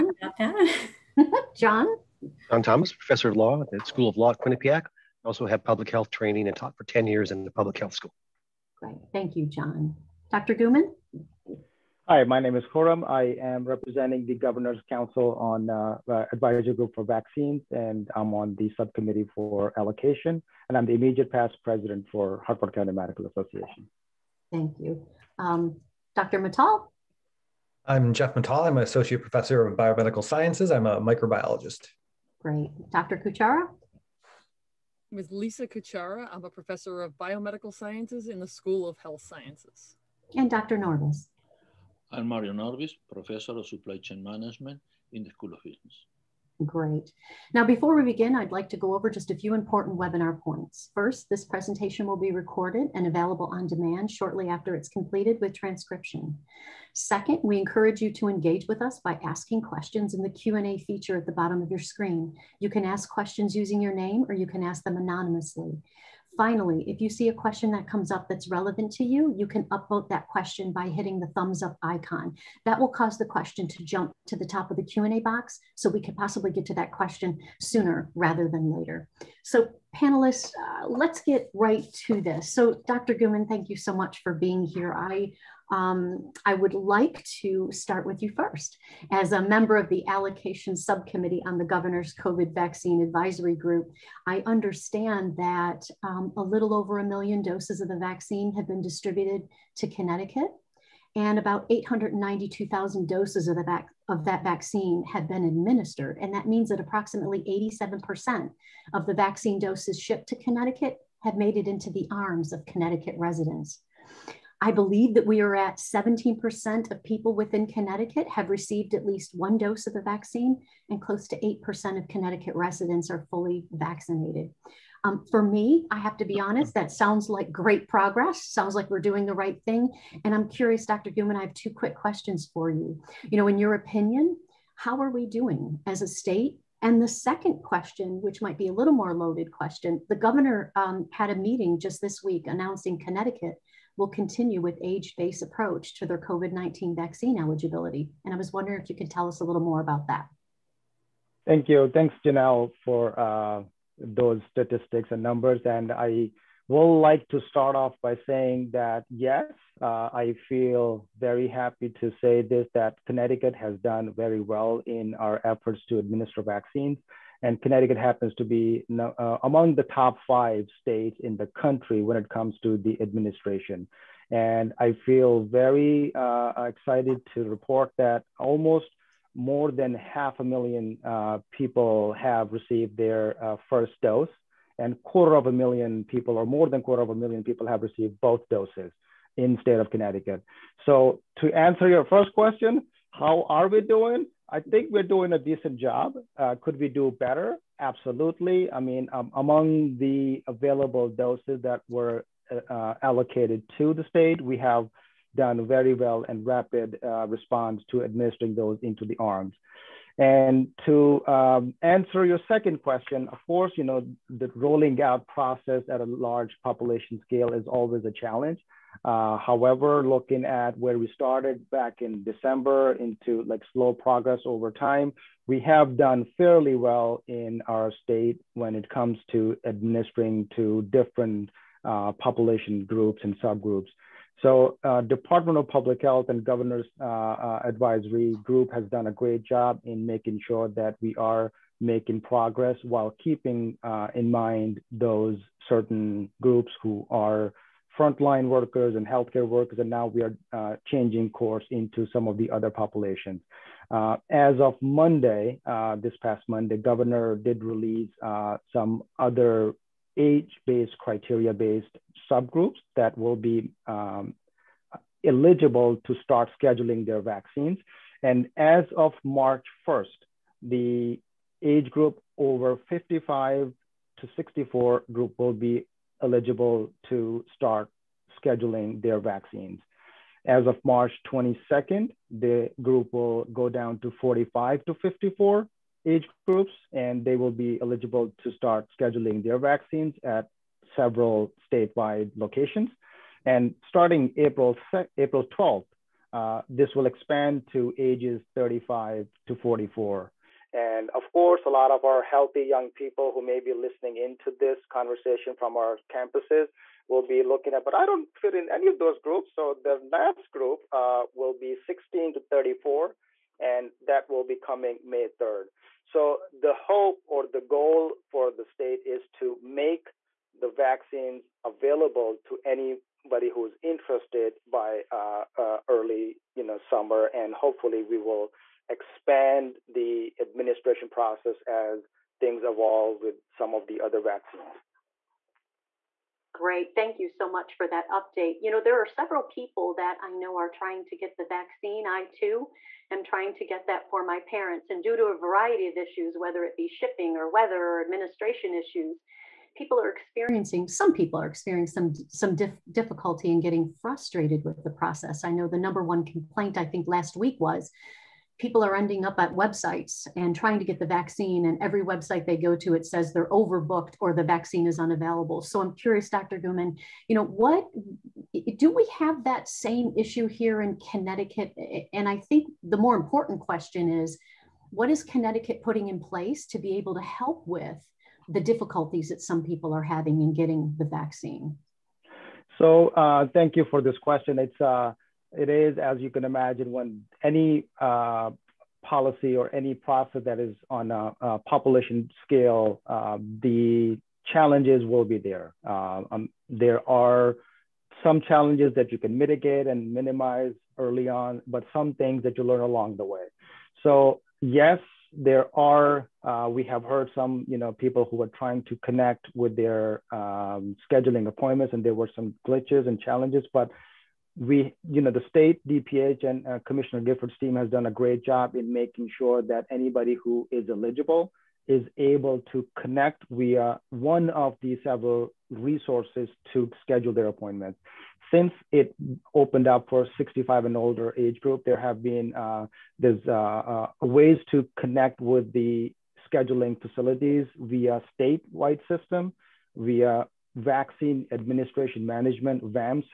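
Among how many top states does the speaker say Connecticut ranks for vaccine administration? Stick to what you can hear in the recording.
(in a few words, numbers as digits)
top 5.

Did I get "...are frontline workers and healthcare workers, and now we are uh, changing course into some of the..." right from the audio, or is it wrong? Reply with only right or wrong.
right.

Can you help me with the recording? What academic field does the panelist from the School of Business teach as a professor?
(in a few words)
Supply Chain Management.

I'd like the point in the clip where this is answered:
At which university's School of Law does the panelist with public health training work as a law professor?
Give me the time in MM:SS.
00:04.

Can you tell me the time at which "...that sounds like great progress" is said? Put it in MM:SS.
02:06.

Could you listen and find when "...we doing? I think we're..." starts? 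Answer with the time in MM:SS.
03:13.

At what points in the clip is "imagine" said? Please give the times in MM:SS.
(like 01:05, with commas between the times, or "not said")
06:26.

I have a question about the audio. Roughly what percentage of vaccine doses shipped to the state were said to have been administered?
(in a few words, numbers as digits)
87%.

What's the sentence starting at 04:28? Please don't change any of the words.
And as of March 1st, the age group over 55 to 64 group will be eligible to start scheduling their vaccines.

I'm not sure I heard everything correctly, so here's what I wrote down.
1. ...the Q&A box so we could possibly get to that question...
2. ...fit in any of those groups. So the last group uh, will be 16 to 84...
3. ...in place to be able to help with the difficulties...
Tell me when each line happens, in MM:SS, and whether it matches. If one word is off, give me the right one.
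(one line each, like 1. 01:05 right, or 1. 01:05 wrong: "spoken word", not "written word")
1. 01:14 right
2. 05:08 wrong: "34", not "84"
3. 06:16 right.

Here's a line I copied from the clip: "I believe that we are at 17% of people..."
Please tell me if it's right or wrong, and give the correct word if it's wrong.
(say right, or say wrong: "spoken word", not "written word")
right.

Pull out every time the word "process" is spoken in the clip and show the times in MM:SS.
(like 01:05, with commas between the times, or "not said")
03:35, 05:31, 05:54, 06:29.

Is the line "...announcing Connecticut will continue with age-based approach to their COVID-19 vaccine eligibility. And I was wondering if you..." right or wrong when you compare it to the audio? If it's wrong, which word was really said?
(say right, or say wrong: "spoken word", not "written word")
right.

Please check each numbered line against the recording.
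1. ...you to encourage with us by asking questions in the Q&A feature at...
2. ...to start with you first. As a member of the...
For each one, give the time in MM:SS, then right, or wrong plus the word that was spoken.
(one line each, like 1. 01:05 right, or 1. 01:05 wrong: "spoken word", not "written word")
1. 00:58 wrong: "engage", not "encourage"
2. 01:27 right.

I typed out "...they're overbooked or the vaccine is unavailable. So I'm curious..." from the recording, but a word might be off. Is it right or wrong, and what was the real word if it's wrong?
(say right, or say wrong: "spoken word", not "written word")
right.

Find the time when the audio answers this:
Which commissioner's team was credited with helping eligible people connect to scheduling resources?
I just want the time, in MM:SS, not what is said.
06:56.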